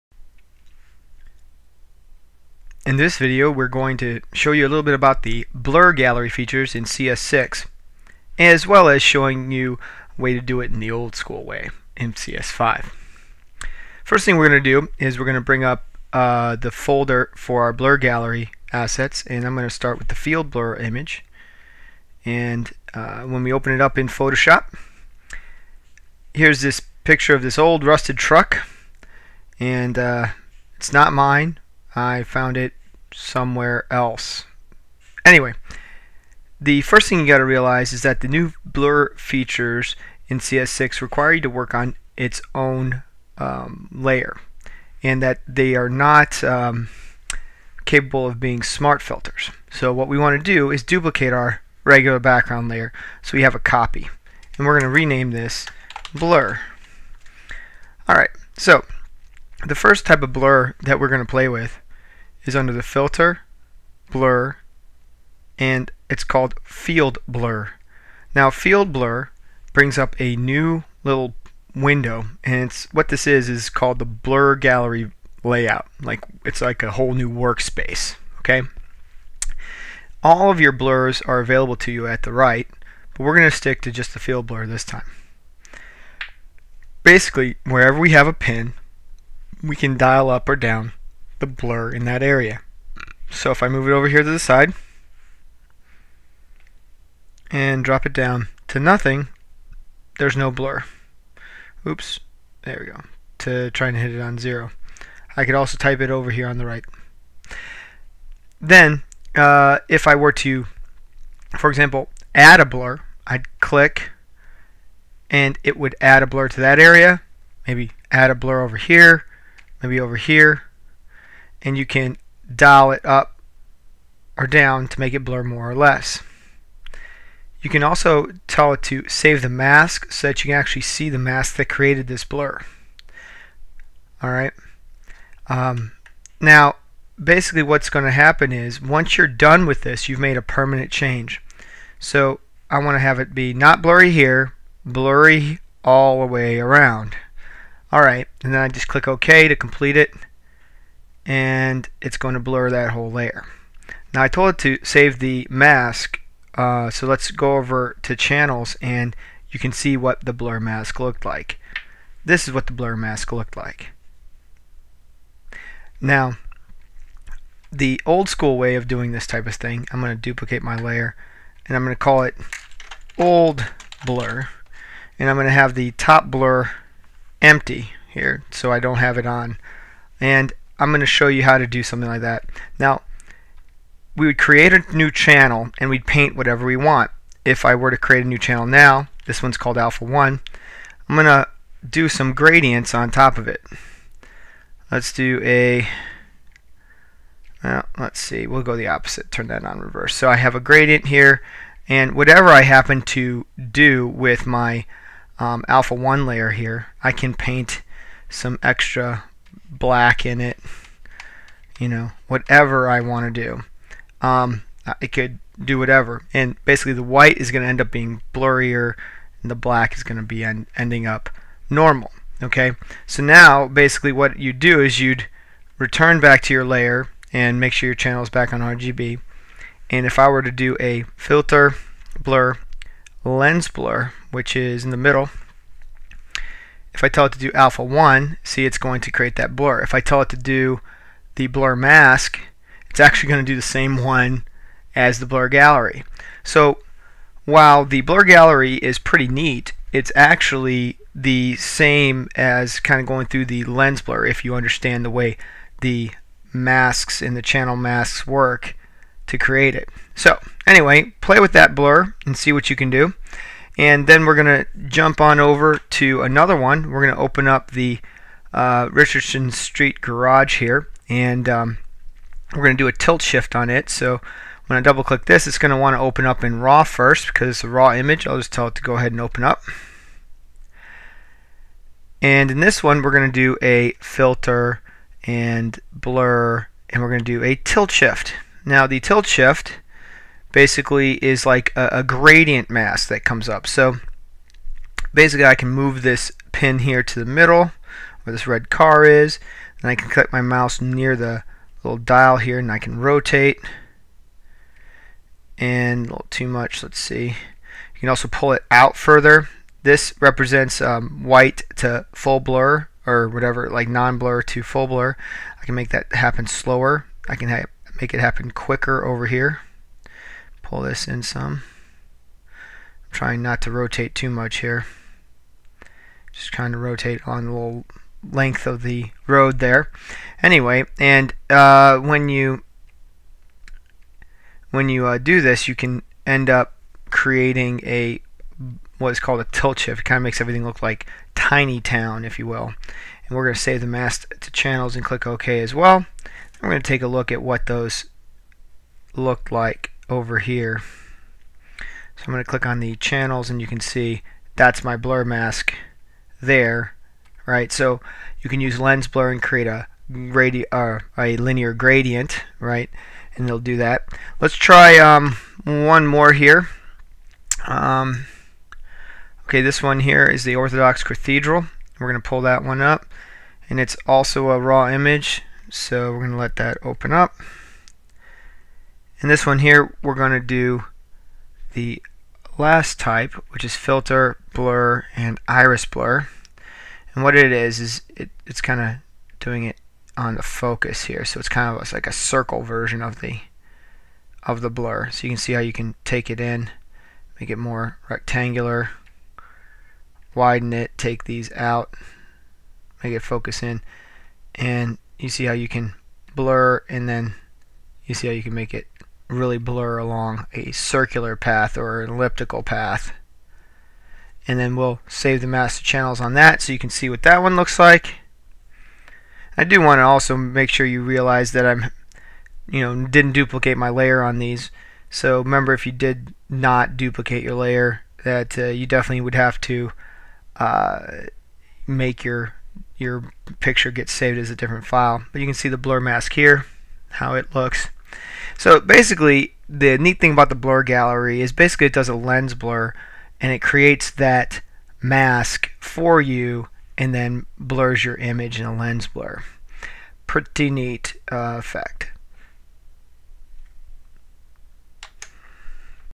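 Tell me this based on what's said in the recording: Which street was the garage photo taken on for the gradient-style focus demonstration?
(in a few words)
Richardson Street.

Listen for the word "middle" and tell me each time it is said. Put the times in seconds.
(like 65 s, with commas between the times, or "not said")
234 s, 297 s.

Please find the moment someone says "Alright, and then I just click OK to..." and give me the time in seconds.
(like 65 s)
147 s.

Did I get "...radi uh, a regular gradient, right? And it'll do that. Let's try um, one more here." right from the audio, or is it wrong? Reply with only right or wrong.
wrong.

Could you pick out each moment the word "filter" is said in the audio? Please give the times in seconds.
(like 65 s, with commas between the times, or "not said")
49 s, 62 s, 231 s, 283 s, 383 s.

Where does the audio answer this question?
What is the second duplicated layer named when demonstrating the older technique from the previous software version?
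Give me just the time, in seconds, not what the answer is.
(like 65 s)
173 s.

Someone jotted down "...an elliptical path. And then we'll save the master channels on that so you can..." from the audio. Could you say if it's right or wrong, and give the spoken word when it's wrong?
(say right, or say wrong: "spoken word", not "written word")
right.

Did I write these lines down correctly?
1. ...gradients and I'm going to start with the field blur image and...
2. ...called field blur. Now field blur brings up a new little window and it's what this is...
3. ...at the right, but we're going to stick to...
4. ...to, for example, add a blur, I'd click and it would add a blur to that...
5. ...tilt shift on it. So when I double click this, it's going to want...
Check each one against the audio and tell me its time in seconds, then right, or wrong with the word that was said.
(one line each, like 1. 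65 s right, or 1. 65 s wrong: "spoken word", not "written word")
1. 18 s wrong: "assets", not "gradients"
2. 66 s right
3. 82 s right
4. 110 s right
5. 272 s right.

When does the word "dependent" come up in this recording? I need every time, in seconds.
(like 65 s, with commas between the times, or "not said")
not said.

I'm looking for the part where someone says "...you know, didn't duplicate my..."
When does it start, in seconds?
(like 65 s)
422 s.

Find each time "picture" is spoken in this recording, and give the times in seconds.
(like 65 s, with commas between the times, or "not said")
27 s, 433 s.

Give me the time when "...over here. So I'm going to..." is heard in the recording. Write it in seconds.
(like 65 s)
350 s.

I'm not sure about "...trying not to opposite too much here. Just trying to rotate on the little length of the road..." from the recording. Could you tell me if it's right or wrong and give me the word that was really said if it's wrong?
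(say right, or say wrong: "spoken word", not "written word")
wrong: "rotate", not "opposite".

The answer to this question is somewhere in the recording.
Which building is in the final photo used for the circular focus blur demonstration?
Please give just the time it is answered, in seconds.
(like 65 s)
370 s.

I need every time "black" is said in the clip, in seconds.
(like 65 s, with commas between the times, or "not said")
209 s, 219 s.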